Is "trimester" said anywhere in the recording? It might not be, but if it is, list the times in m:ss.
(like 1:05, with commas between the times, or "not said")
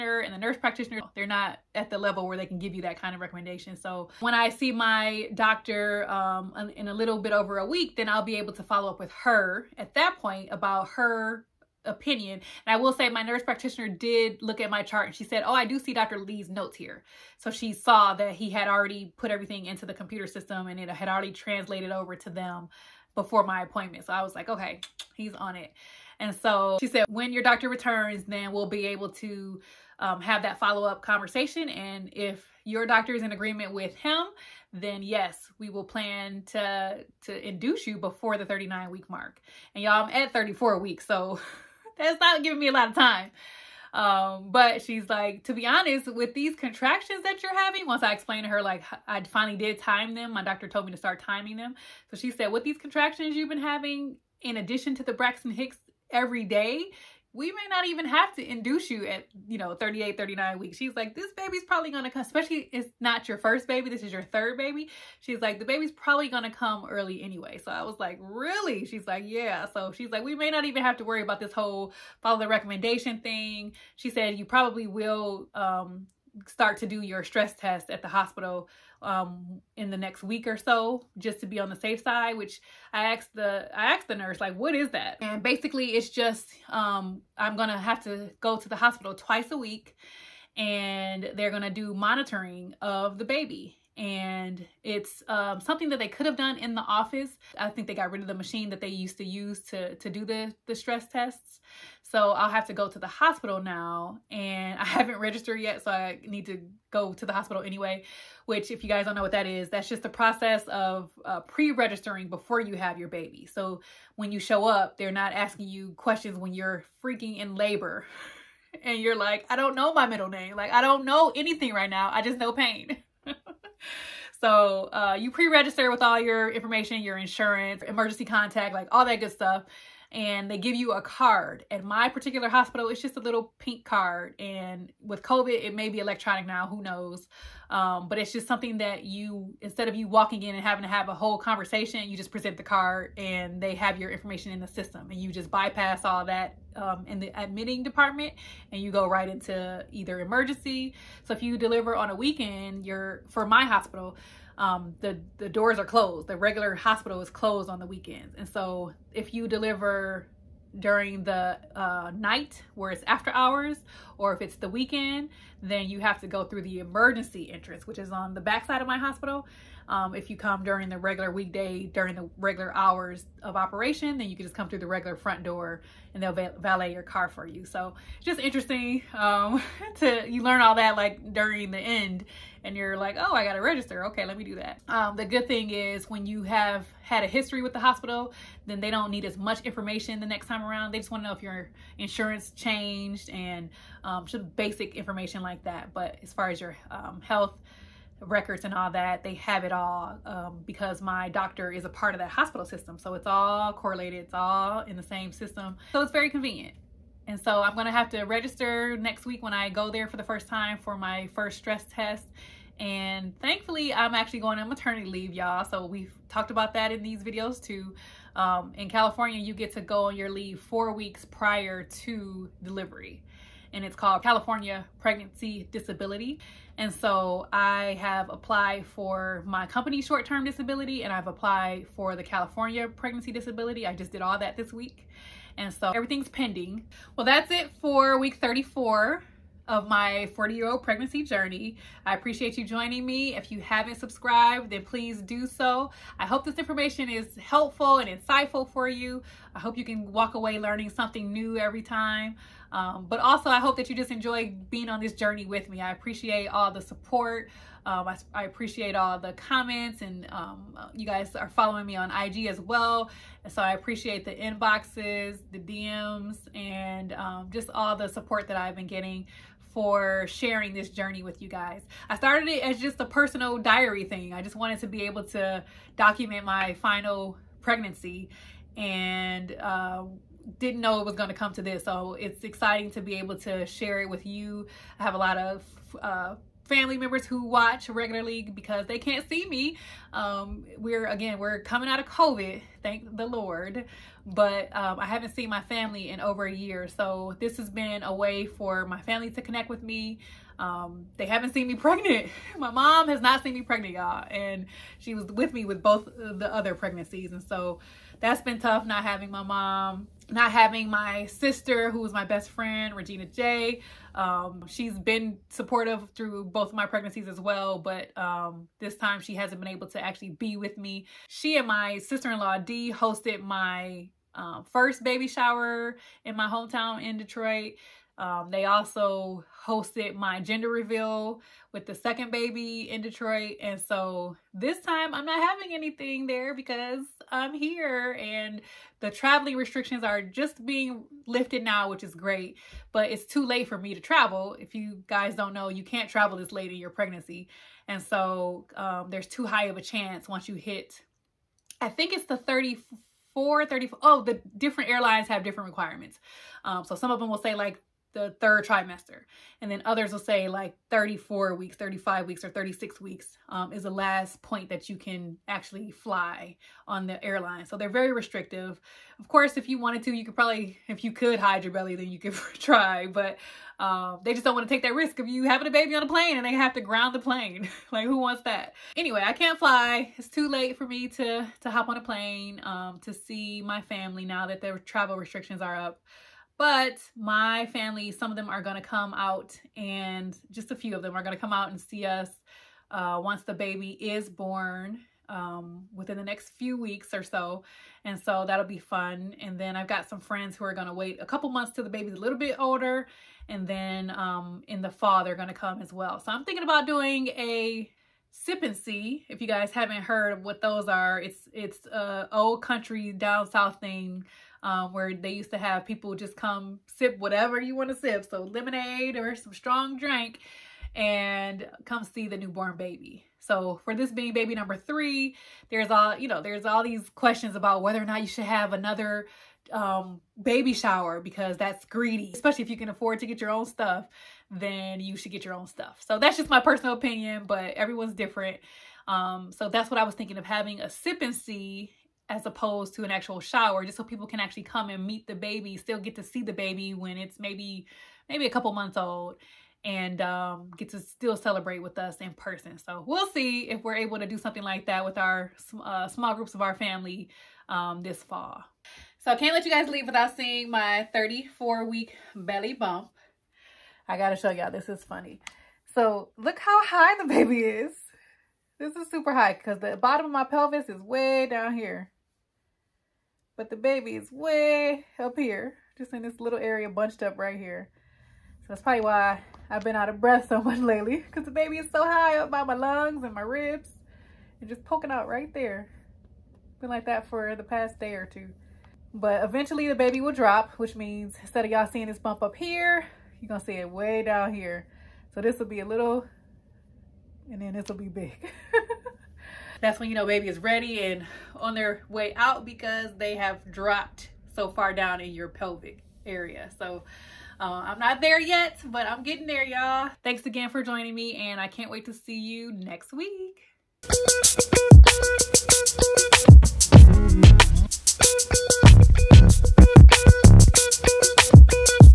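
5:58.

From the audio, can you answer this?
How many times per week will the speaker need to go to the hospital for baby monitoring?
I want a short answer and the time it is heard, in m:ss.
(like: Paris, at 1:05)
2, at 1:29.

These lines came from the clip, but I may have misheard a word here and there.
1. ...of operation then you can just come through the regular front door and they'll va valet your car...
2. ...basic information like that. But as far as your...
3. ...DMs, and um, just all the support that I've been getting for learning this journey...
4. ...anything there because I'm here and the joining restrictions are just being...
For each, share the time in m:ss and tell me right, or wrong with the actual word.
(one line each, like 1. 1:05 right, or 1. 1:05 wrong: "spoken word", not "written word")
1. 2:53 right
2. 3:14 right
3. 4:25 wrong: "sharing", not "learning"
4. 5:35 wrong: "traveling", not "joining".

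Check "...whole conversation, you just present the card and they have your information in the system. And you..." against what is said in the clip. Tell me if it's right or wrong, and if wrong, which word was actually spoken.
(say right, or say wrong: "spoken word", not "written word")
right.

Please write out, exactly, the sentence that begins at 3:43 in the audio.
And it's called California Pregnancy Disability.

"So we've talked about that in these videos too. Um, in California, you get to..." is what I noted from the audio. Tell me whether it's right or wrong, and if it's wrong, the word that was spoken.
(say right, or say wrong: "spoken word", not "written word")
right.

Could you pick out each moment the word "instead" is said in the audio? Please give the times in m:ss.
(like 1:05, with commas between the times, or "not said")
2:19, 8:11.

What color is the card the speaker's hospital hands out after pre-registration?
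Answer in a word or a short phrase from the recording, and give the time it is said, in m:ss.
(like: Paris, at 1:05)
Pink, at 2:13.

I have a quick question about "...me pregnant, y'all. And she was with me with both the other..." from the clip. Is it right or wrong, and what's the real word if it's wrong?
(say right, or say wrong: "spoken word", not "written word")
right.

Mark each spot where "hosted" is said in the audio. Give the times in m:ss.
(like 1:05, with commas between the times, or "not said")
5:22, 5:29.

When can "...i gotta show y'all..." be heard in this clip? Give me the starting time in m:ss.
7:44.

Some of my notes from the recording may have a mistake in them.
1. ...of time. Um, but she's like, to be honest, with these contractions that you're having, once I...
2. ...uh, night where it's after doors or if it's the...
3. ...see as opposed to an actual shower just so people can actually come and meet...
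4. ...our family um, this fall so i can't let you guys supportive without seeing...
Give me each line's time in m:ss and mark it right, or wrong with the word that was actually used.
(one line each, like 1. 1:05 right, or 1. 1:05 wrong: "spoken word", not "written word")
1. 0:42 right
2. 2:41 wrong: "hours", not "doors"
3. 7:21 right
4. 7:36 wrong: "leave", not "supportive".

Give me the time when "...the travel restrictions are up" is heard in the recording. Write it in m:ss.
6:24.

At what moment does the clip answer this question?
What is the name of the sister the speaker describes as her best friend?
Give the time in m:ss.
5:12.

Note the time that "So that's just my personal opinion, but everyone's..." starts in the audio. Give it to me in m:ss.
7:16.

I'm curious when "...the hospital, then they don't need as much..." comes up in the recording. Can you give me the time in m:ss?
3:07.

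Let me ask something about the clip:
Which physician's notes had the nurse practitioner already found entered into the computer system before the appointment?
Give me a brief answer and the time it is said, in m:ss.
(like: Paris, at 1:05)
Dr. Lee, at 0:15.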